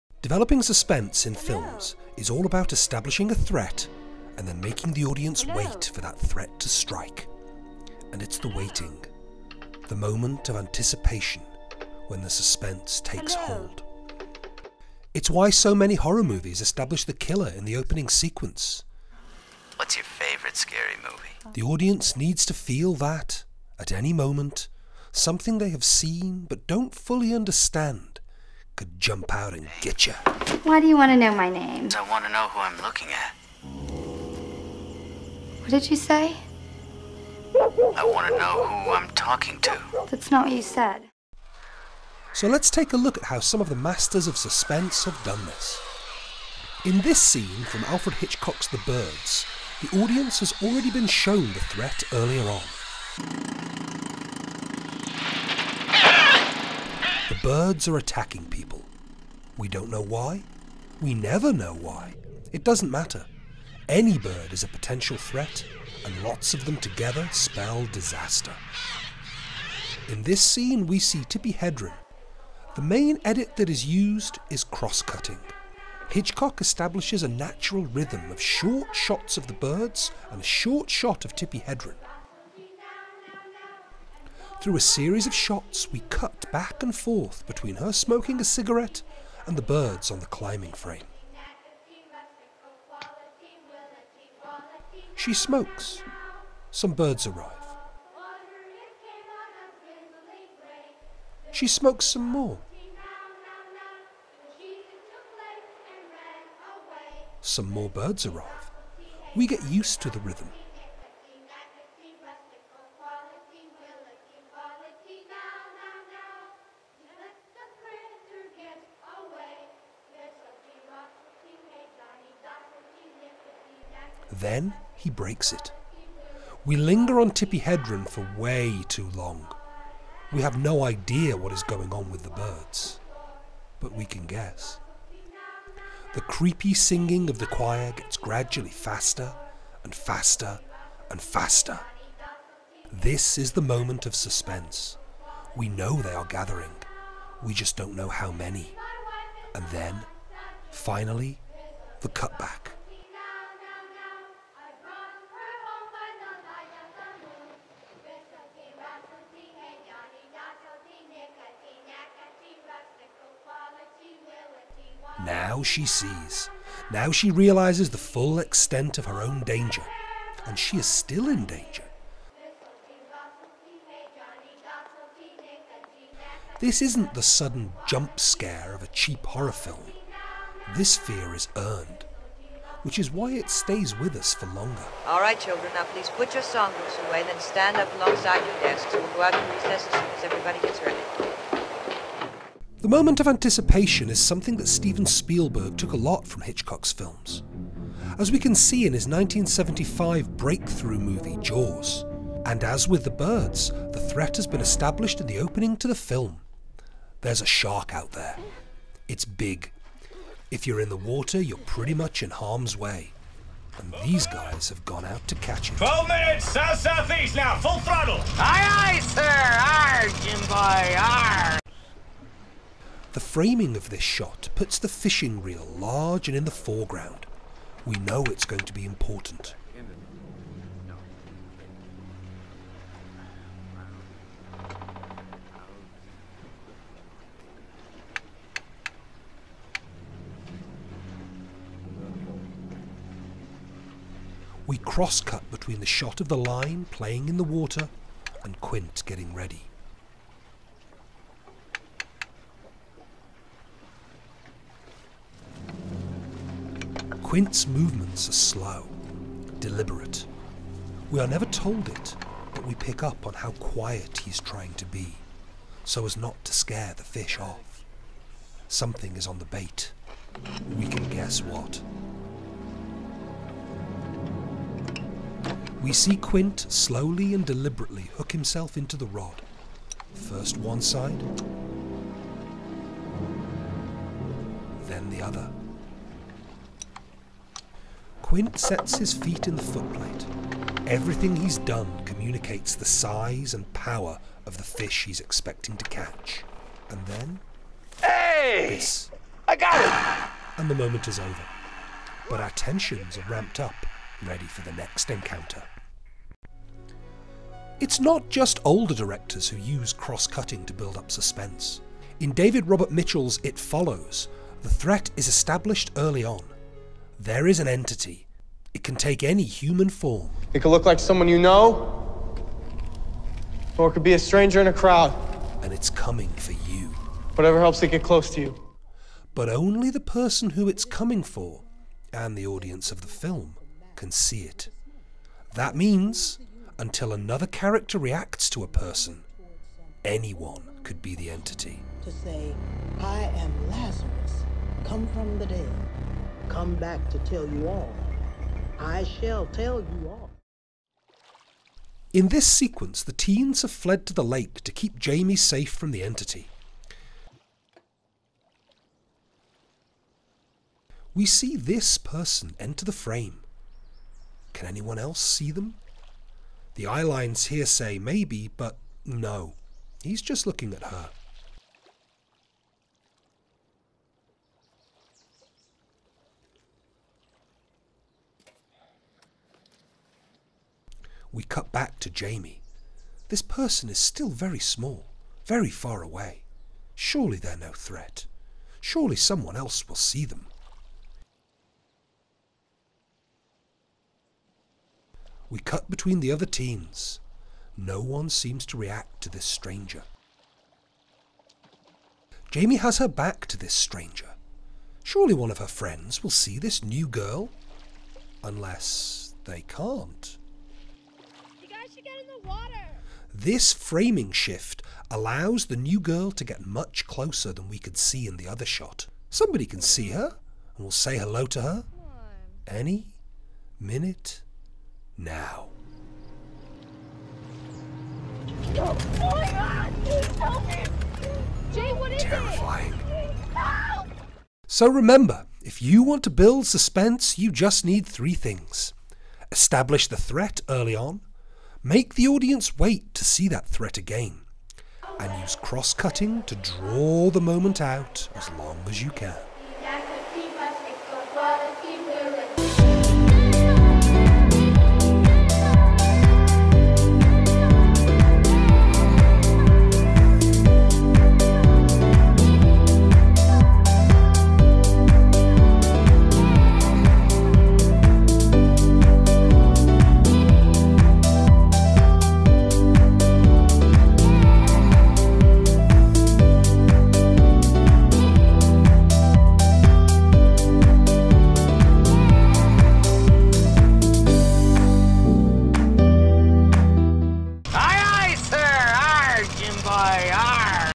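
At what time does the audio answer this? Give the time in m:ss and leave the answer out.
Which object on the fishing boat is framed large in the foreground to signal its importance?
3:44.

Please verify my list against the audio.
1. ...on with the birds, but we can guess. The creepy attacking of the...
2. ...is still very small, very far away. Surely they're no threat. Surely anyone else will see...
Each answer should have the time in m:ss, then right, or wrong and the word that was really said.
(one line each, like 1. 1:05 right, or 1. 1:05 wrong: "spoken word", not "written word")
1. 2:11 wrong: "singing", not "attacking"
2. 6:23 wrong: "someone", not "anyone".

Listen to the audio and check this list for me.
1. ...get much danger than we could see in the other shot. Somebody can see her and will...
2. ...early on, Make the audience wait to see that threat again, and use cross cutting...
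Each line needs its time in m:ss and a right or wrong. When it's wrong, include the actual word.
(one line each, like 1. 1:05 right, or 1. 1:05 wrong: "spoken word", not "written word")
1. 6:56 wrong: "closer", not "danger"
2. 7:20 right.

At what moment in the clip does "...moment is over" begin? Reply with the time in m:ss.
5:00.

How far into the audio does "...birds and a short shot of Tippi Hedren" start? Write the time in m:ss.
1:19.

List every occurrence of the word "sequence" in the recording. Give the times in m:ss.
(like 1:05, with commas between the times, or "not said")
0:18, 5:52.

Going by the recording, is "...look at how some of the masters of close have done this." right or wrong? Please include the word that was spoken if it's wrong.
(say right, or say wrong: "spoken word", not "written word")
wrong: "suspense", not "close".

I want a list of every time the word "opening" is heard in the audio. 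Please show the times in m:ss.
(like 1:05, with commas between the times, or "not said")
0:17, 3:25.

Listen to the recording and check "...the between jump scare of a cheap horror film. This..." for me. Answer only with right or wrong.
wrong.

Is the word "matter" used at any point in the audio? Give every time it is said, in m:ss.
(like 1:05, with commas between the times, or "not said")
1:02.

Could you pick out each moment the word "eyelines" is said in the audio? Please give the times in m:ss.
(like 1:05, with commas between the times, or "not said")
6:06.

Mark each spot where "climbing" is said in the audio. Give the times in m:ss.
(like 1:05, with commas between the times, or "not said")
1:30.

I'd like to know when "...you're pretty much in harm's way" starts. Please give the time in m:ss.
3:31.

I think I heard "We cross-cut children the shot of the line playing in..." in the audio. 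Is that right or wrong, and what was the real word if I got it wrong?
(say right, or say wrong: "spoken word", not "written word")
wrong: "between", not "children".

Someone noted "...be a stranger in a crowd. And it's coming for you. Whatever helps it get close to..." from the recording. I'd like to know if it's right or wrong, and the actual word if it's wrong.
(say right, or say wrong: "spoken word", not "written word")
right.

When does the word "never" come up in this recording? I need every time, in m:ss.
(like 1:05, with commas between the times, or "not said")
1:01, 4:21.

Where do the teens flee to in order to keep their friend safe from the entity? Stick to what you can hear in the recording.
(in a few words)
The lake.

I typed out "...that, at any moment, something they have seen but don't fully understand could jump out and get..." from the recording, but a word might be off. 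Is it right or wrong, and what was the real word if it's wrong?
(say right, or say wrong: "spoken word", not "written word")
right.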